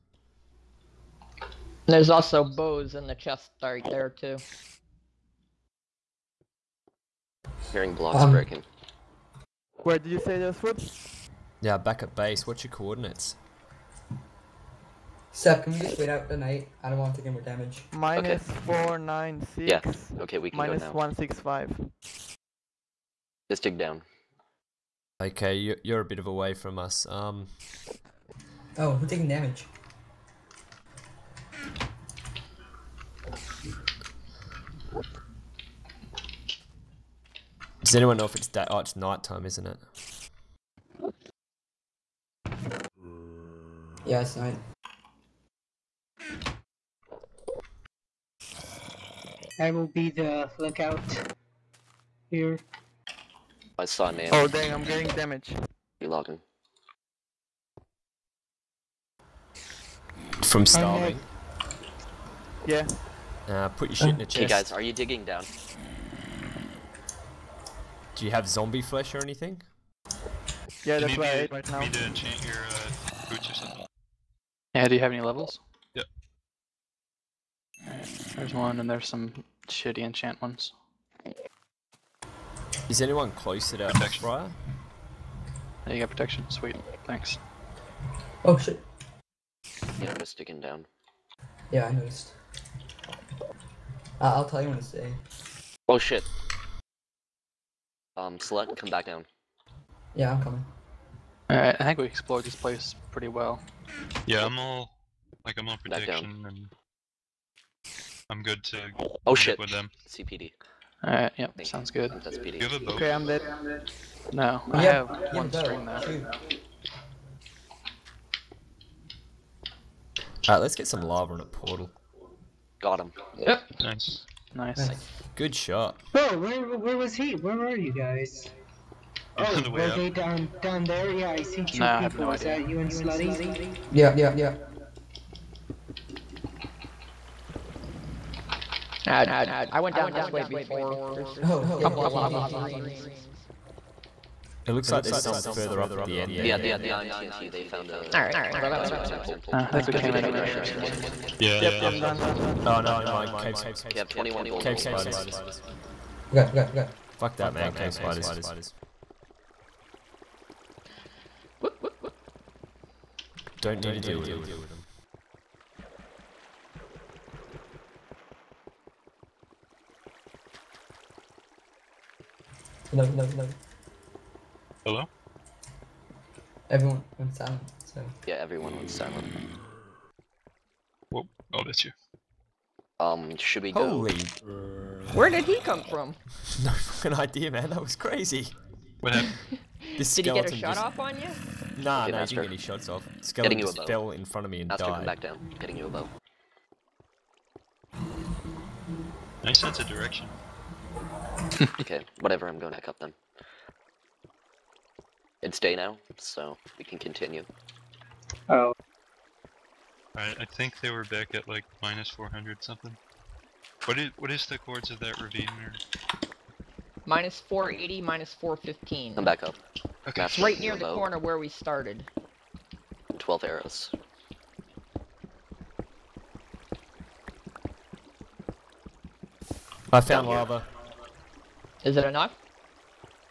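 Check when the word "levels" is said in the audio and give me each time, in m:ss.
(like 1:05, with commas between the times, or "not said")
1:15.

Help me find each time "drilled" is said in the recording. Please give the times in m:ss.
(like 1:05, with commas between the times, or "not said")
not said.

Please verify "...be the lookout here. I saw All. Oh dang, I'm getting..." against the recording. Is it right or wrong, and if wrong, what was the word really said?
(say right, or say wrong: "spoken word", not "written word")
wrong: "Nail", not "All".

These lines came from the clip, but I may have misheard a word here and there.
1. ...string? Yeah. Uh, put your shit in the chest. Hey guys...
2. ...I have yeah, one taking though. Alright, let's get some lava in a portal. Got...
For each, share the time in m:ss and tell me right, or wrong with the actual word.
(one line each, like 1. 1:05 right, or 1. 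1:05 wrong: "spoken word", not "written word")
1. 1:00 wrong: "starving", not "string"
2. 1:54 wrong: "string", not "taking".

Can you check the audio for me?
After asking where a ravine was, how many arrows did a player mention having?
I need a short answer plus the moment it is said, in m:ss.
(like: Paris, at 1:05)
12, at 3:43.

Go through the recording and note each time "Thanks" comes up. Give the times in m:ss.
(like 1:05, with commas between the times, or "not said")
1:27, 1:51.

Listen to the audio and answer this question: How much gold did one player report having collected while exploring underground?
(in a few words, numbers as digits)
21.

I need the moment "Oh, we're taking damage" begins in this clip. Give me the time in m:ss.
0:28.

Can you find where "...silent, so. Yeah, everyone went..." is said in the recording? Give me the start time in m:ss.
2:57.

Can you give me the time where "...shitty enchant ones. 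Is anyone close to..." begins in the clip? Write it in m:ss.
1:19.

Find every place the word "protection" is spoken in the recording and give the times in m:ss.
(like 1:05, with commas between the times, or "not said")
1:26, 1:45.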